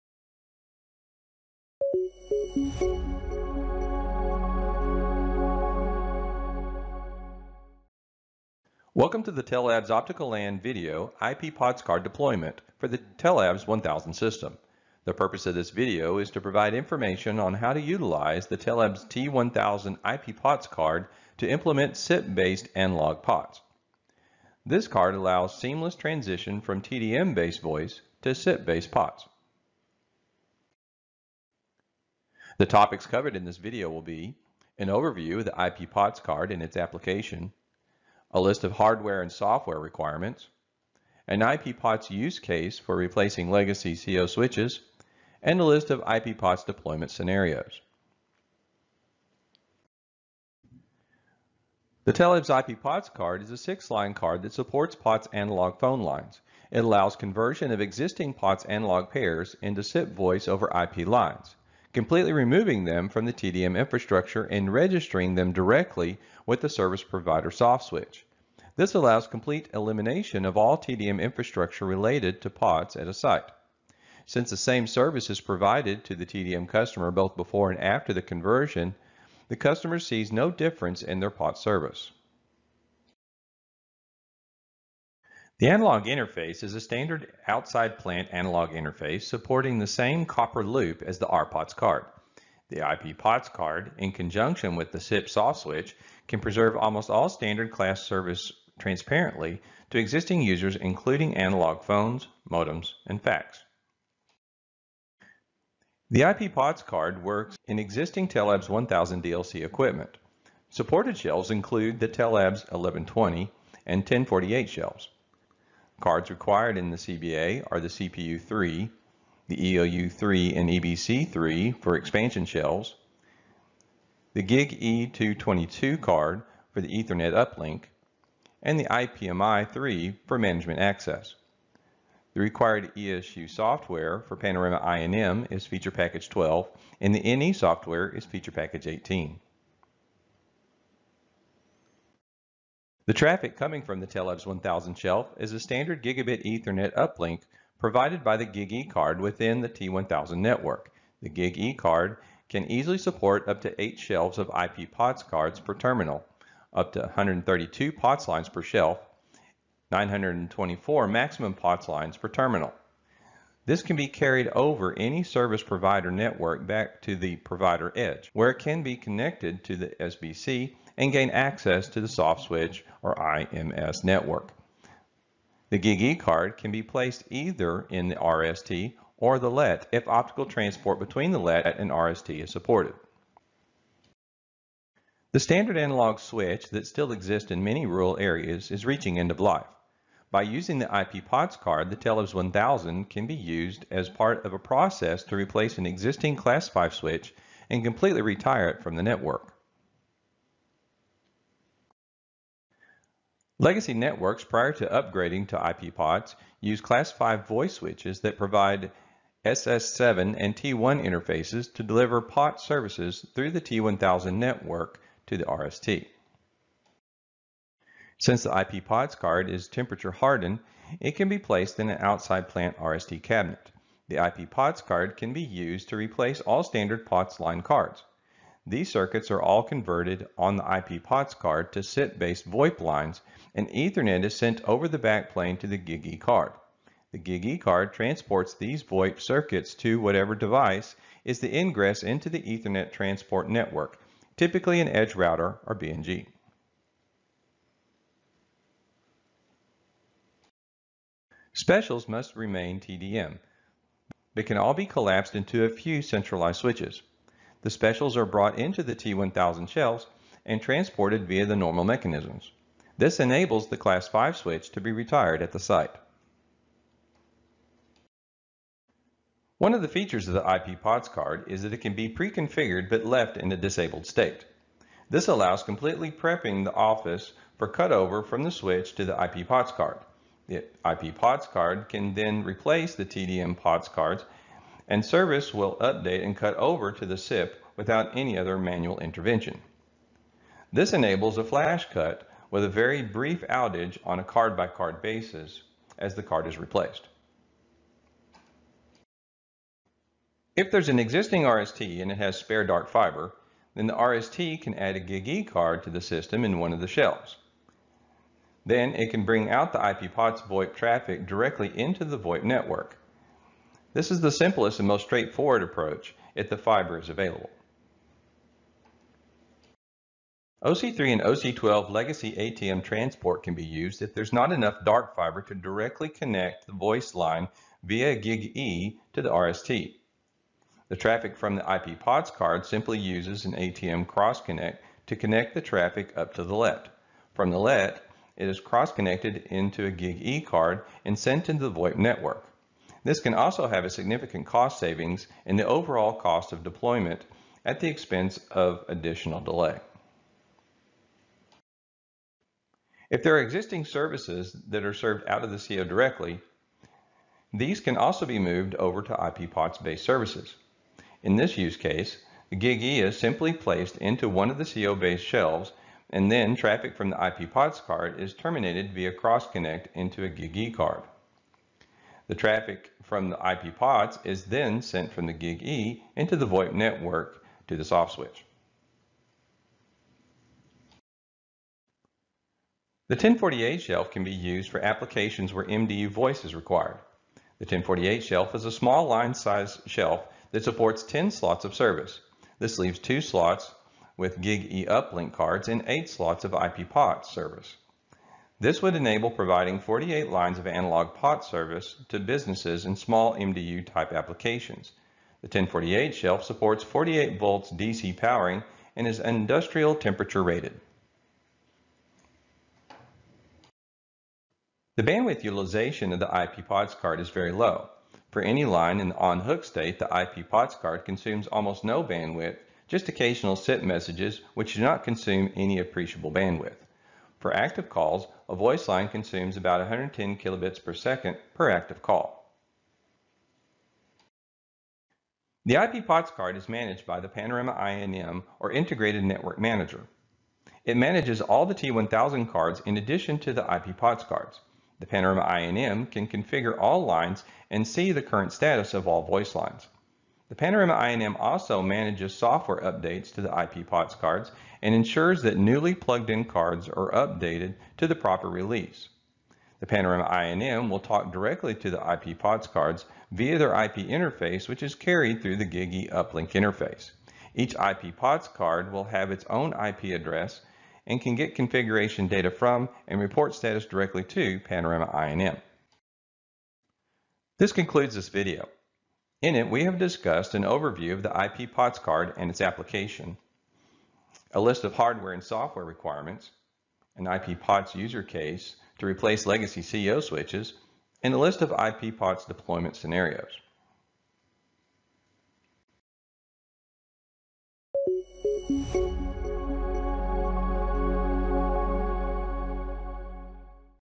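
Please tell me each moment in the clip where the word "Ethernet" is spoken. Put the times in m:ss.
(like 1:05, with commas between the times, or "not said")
2:06, 2:26, 3:53, 4:02.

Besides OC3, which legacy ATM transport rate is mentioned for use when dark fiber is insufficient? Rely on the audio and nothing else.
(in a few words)
OC12.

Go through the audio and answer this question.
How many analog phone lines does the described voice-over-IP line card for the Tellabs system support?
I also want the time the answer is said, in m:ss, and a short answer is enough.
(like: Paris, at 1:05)
6, at 0:53.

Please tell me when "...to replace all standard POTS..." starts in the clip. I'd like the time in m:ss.
3:45.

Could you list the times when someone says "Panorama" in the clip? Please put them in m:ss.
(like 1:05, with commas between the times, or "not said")
2:14, 7:17, 7:25, 7:30, 7:39, 7:54.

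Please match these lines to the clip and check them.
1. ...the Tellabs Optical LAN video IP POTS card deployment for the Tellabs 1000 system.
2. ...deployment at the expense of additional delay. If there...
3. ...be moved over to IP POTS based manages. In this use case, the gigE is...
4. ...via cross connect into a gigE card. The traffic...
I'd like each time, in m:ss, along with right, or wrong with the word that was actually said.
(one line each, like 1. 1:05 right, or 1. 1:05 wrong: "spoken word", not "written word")
1. 0:09 right
2. 5:46 right
3. 5:58 wrong: "services", not "manages"
4. 6:08 right.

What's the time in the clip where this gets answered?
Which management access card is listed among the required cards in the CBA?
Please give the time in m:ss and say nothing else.
2:08.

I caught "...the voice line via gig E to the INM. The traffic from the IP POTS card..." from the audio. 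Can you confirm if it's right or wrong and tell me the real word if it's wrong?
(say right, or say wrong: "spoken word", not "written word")
wrong: "RST", not "INM".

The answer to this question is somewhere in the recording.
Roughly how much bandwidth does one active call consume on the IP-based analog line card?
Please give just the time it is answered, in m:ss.
7:09.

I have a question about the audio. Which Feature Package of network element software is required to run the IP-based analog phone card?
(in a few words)
Feature Package 18.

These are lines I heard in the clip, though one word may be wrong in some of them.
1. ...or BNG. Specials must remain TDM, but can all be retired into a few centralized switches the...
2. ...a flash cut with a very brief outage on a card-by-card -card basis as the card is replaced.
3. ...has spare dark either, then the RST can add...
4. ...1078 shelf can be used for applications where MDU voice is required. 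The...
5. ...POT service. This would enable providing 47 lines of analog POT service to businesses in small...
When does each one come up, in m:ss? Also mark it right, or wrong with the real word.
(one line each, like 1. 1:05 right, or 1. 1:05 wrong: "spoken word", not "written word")
1. 4:05 wrong: "collapsed", not "retired"
2. 4:51 right
3. 5:02 wrong: "fiber", not "either"
4. 6:23 wrong: "1048", not "1078"
5. 6:36 wrong: "48", not "47".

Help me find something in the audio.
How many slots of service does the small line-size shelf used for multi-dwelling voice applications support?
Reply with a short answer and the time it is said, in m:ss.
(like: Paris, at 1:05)
10, at 6:31.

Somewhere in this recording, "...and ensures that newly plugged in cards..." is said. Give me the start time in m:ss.
7:34.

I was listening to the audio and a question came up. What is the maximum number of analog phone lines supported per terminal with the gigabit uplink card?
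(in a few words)
924.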